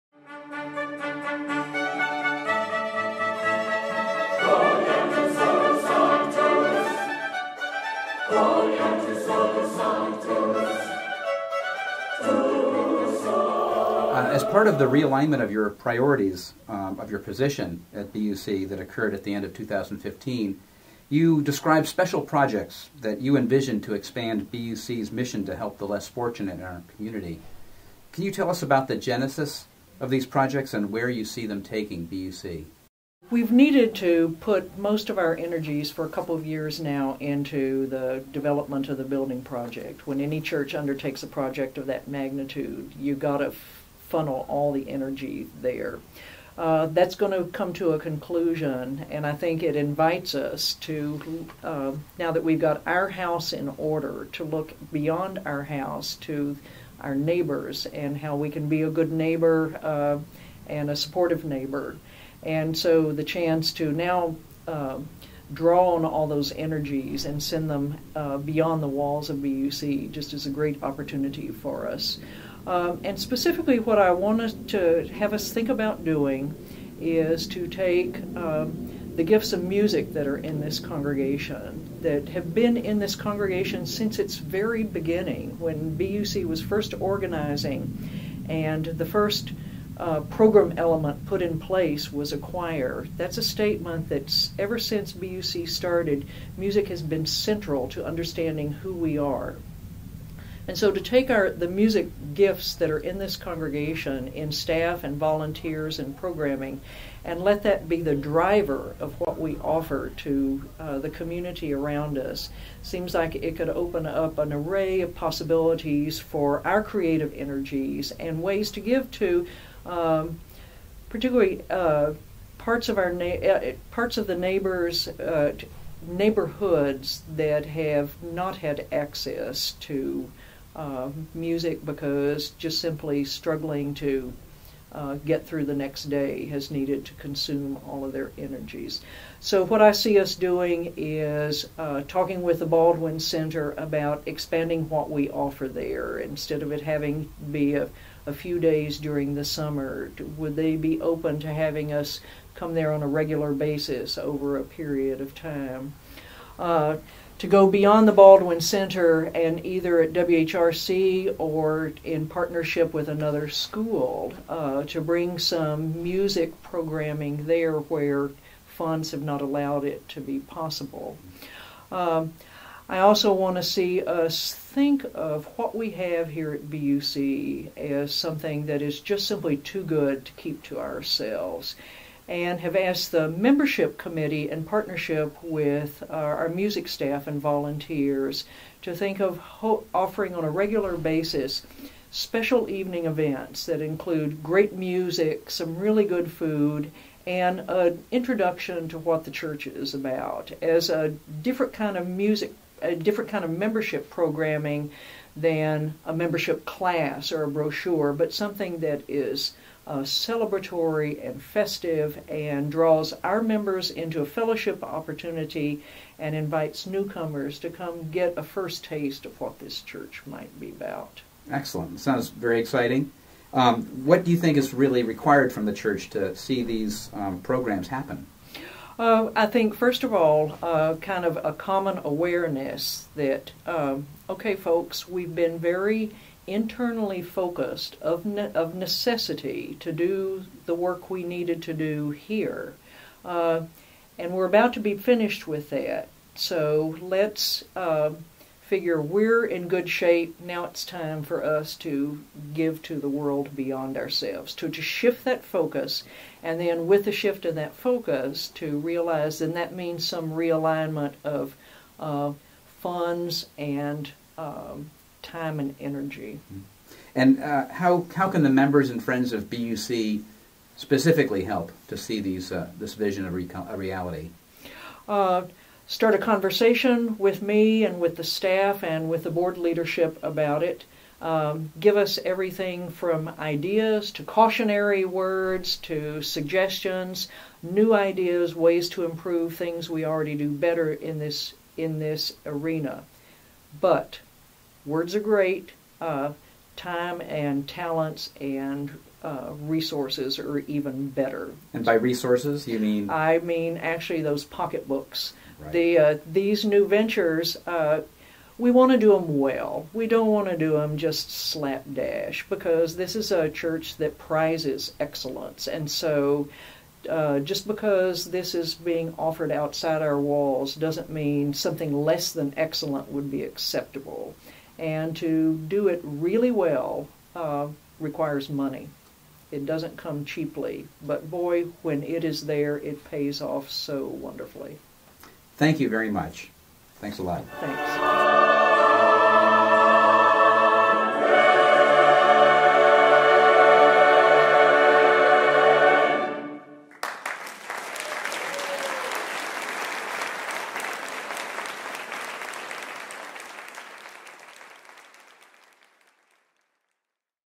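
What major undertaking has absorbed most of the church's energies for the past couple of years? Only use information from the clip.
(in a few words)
the building project.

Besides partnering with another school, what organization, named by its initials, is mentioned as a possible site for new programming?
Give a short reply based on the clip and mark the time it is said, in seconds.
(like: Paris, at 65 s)
WHRC, at 160 s.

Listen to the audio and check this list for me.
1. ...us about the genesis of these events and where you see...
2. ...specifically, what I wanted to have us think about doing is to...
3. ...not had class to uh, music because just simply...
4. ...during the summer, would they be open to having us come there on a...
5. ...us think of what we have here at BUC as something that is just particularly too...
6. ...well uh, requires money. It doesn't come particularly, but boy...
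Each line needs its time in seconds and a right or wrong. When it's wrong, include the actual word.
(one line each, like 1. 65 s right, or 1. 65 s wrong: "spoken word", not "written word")
1. 28 s wrong: "projects", not "events"
2. 73 s right
3. 128 s wrong: "access", not "class"
4. 148 s right
5. 174 s wrong: "simply", not "particularly"
6. 326 s wrong: "cheaply", not "particularly".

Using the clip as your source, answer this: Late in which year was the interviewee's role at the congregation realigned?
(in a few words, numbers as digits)
2015.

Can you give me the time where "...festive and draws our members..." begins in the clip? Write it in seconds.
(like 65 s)
211 s.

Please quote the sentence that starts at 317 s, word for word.
Uh, just because this is being offered outside our walls doesn't mean something less than excellent would be acceptable.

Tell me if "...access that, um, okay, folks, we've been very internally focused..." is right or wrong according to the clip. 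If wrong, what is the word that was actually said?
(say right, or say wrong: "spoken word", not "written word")
wrong: "awareness", not "access".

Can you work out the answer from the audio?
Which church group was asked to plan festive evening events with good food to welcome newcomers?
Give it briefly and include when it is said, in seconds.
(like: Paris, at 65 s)
membership committee, at 183 s.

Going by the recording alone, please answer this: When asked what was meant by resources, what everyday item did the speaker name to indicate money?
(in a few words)
pocketbooks.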